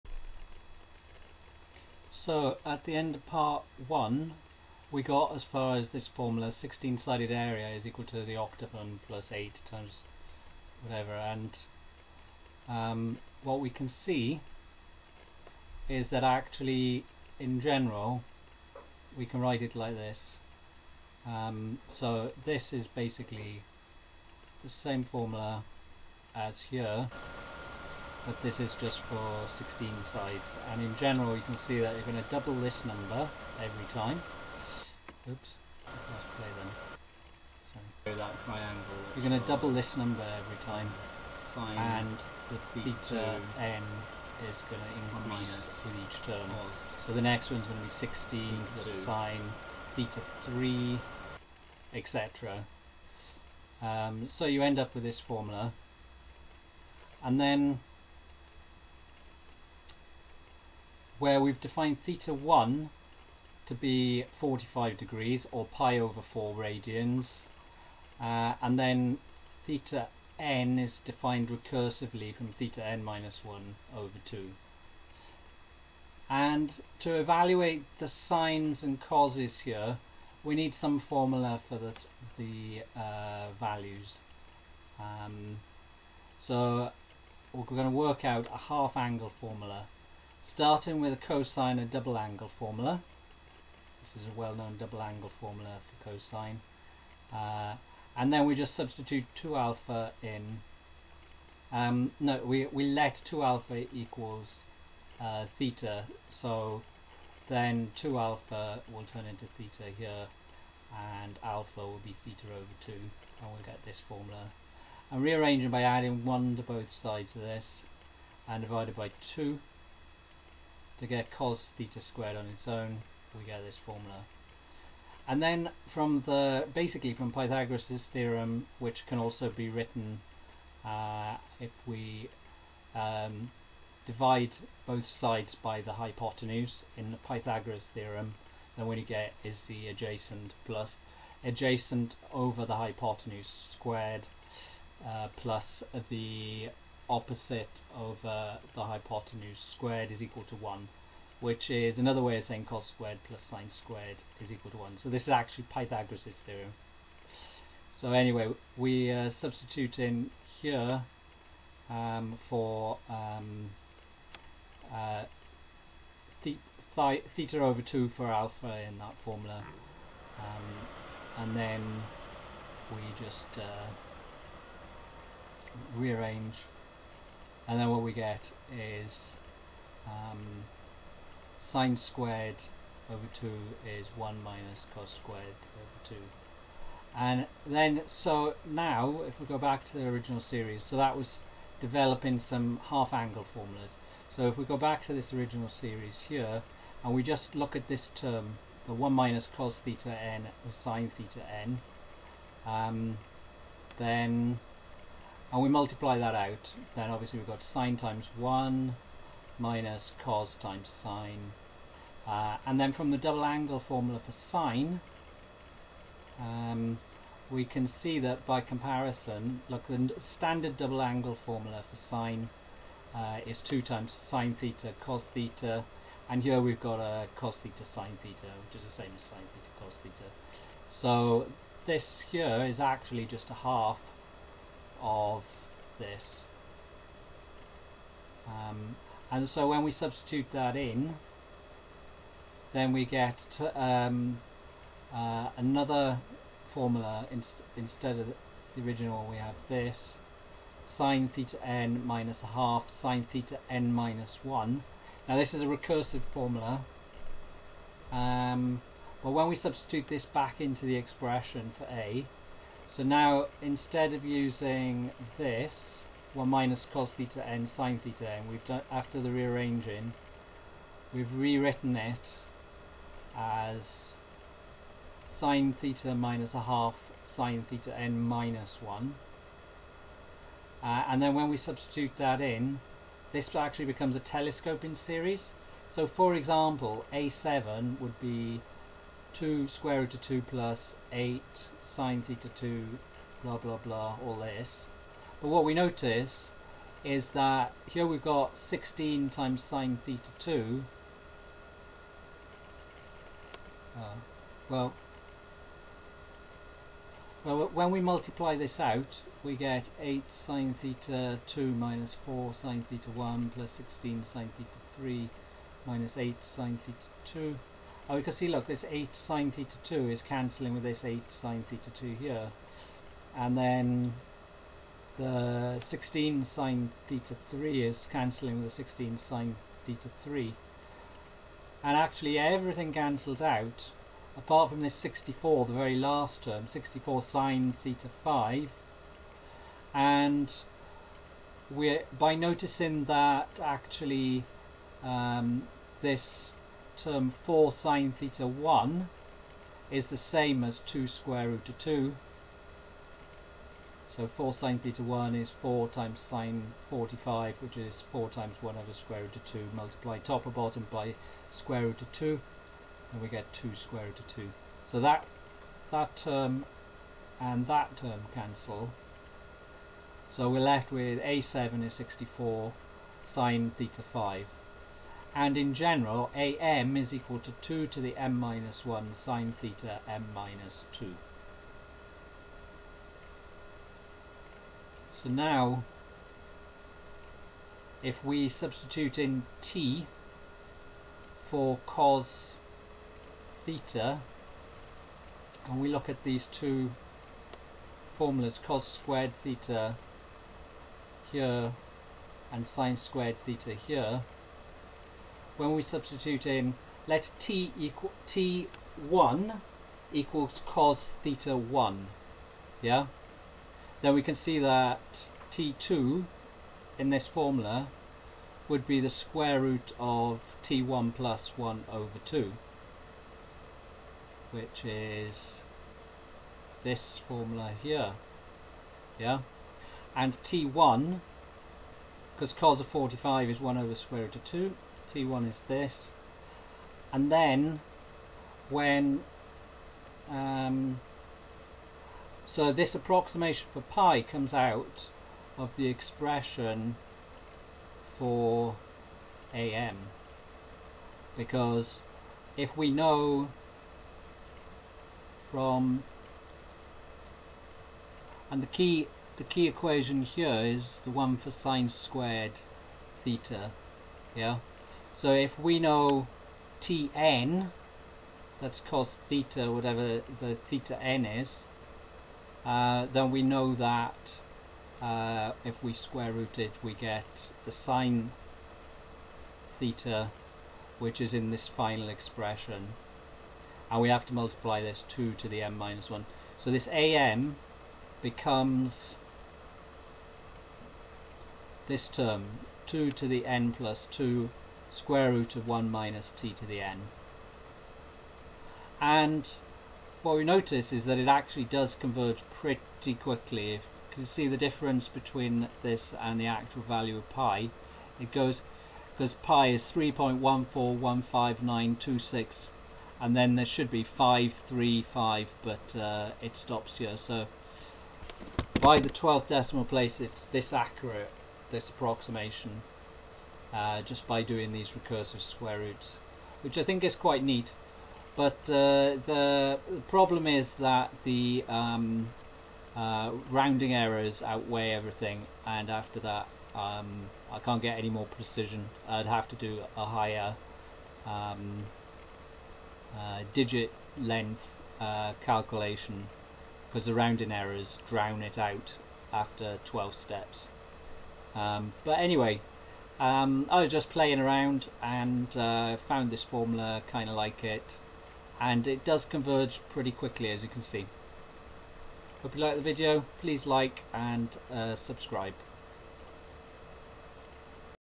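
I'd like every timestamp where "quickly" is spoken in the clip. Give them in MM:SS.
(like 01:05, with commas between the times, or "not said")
08:23, 09:20.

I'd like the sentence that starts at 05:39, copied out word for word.
And we're by noticing that actually um, this term 4 sine theta 1 is the same as 2 square root of 2.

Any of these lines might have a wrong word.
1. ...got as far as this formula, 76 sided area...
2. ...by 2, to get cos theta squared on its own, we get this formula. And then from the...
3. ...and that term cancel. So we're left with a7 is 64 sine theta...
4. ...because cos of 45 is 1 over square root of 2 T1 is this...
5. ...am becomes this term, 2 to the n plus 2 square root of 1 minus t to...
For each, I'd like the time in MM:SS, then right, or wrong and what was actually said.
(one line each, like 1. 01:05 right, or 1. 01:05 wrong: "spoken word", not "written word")
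1. 00:05 wrong: "16", not "76"
2. 01:58 right
3. 06:07 right
4. 07:12 right
5. 08:06 right.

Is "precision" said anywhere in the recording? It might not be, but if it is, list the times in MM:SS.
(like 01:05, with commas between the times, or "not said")
08:58.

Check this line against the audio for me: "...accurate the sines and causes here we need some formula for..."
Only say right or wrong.
wrong.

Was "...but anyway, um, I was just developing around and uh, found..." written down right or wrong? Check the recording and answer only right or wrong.
wrong.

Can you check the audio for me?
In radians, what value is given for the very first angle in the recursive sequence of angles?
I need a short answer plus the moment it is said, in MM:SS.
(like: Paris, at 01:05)
pi over 4, at 01:05.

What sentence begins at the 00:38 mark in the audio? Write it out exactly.
so that triangle you're going to double this number every time Fine.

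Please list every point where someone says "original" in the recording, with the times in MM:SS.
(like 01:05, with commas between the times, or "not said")
03:10, 03:15, 04:08.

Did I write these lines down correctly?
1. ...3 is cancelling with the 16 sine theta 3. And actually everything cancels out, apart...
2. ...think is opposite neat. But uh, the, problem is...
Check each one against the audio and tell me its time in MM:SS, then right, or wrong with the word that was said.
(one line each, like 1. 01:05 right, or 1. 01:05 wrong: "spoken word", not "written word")
1. 05:27 right
2. 08:46 wrong: "quite", not "opposite".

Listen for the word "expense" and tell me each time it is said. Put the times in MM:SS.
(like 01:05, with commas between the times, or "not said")
not said.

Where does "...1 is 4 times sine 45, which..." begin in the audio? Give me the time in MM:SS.
05:55.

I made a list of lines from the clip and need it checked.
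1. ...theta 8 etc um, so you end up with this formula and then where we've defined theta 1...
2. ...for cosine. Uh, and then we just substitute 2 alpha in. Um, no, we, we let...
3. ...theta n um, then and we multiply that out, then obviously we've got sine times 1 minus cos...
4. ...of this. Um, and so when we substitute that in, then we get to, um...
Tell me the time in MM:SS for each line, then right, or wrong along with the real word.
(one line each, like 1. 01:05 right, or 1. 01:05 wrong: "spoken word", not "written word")
1. 00:49 wrong: "3", not "8"
2. 01:36 right
3. 03:21 right
4. 03:55 right.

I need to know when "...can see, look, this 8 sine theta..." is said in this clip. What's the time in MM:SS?
05:18.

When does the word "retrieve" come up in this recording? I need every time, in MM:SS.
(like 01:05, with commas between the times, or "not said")
not said.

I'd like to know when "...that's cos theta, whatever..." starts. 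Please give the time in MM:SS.
07:48.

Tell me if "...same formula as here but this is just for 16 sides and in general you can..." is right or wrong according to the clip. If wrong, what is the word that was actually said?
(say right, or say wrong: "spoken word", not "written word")
right.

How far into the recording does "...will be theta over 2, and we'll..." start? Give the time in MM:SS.
01:51.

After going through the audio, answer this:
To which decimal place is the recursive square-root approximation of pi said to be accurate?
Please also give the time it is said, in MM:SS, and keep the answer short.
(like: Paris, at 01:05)
12th, at 08:39.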